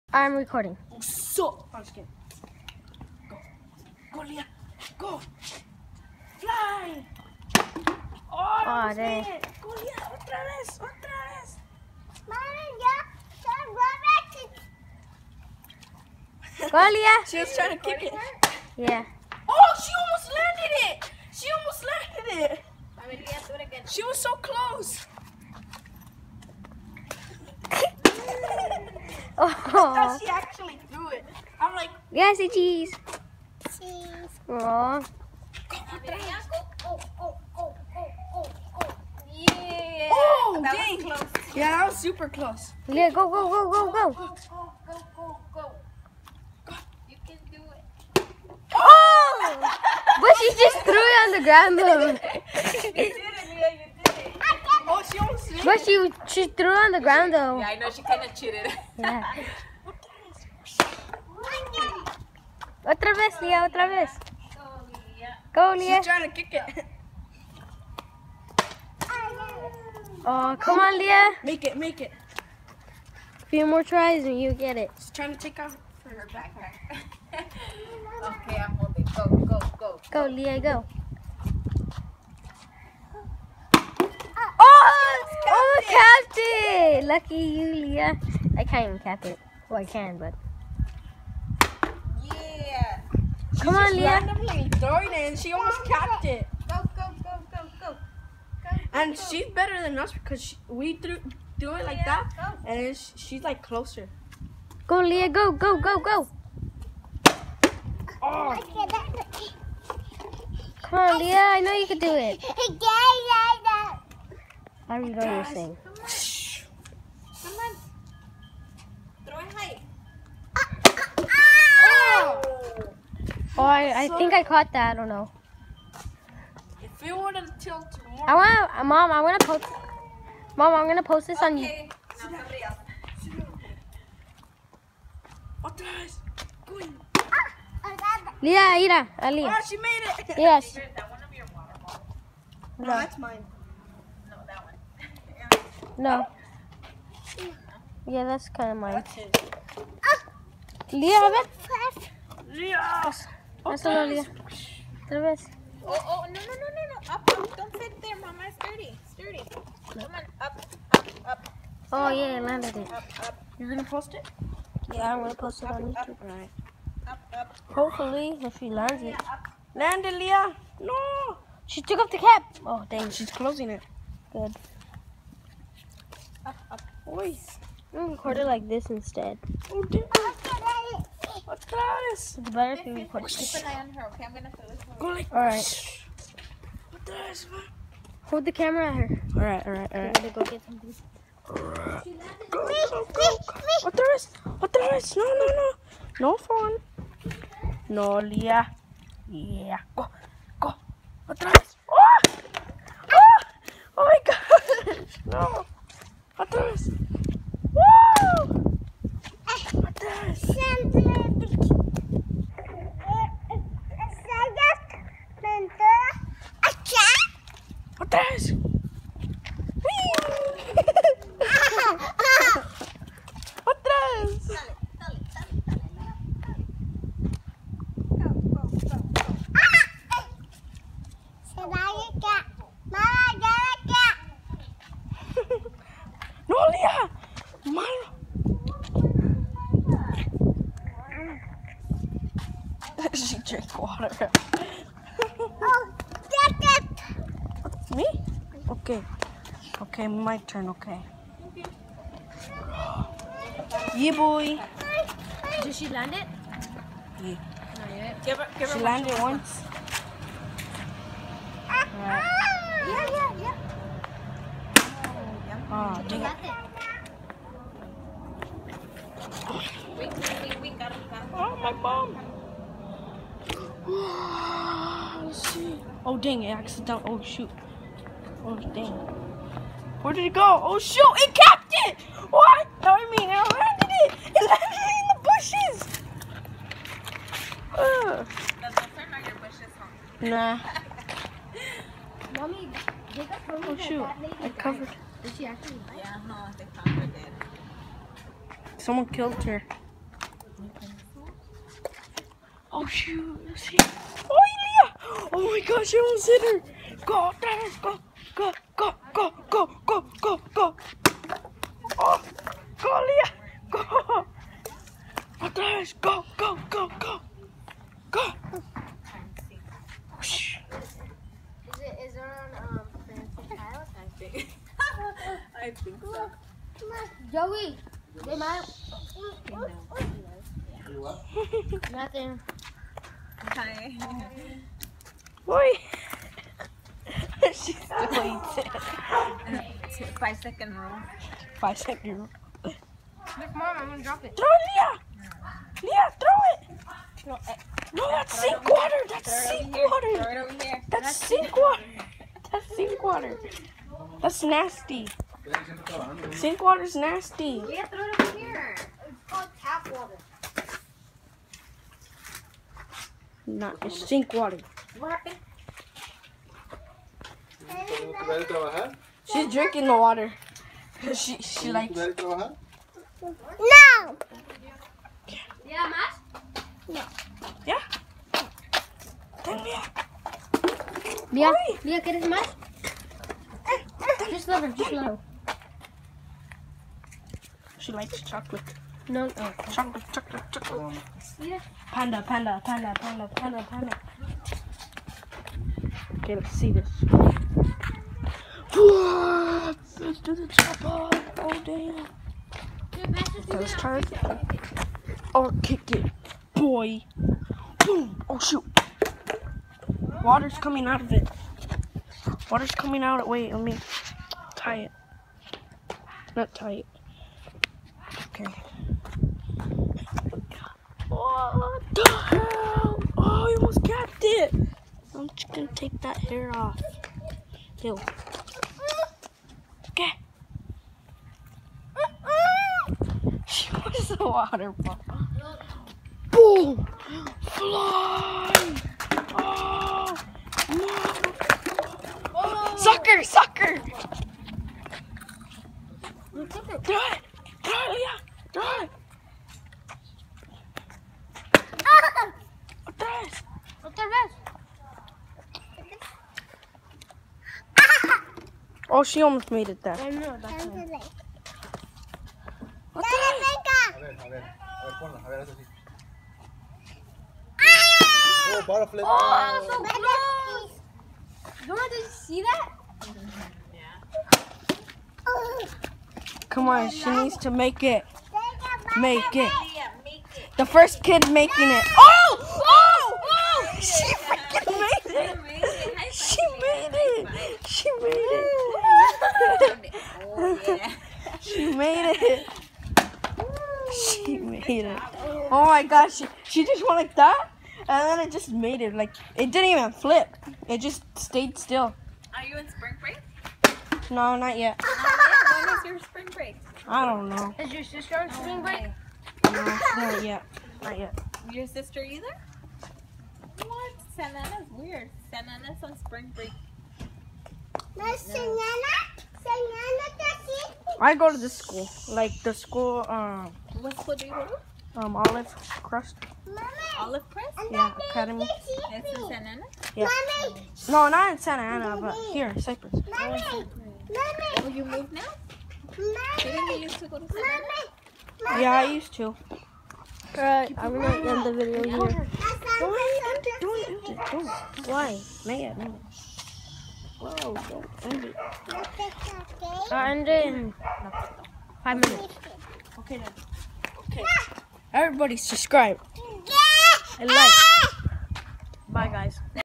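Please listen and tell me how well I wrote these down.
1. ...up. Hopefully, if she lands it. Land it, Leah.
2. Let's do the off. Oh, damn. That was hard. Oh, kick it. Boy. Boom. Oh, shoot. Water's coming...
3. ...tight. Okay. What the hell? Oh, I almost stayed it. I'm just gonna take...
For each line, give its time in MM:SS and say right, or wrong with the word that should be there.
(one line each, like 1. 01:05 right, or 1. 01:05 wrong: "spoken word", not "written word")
1. 02:47 right
2. 06:38 right
3. 06:56 wrong: "capped", not "stayed".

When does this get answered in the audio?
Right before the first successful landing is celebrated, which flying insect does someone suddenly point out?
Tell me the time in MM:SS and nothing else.
07:48.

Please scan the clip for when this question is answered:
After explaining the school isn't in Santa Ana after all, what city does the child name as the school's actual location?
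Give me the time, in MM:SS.
08:52.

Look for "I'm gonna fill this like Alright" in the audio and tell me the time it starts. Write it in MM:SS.
03:04.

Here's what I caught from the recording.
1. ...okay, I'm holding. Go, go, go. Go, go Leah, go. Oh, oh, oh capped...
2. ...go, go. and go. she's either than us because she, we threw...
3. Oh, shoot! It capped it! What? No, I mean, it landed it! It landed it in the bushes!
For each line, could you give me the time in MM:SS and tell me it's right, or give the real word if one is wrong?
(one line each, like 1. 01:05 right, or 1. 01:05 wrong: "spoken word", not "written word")
1. 01:18 right
2. 01:37 wrong: "better", not "either"
3. 04:40 right.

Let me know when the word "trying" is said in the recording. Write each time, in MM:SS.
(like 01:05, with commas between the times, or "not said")
00:17, 01:06, 01:15.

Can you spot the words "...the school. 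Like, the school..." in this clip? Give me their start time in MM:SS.
08:41.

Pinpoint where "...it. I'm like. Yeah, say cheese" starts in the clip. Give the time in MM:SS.
00:31.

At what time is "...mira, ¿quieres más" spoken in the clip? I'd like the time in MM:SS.
06:21.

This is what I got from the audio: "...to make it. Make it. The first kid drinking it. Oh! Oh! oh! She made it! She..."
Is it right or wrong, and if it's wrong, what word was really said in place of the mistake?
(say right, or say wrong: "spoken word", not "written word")
wrong: "making", not "drinking".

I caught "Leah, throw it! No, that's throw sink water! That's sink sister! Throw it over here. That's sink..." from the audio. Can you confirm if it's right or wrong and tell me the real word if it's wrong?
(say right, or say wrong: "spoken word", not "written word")
wrong: "water", not "sister".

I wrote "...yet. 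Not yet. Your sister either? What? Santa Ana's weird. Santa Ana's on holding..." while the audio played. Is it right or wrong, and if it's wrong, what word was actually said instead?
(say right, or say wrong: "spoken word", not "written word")
wrong: "spring", not "holding".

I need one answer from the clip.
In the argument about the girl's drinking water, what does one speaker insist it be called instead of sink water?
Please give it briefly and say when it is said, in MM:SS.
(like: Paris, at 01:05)
tap water, at 05:59.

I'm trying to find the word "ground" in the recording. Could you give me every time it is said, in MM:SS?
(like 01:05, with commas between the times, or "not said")
00:51, 00:56.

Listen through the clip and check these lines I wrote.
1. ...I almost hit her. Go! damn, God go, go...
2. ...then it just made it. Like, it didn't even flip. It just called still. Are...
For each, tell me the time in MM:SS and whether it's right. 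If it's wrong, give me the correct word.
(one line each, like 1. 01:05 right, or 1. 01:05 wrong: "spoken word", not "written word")
1. 05:05 right
2. 08:18 wrong: "stayed", not "called".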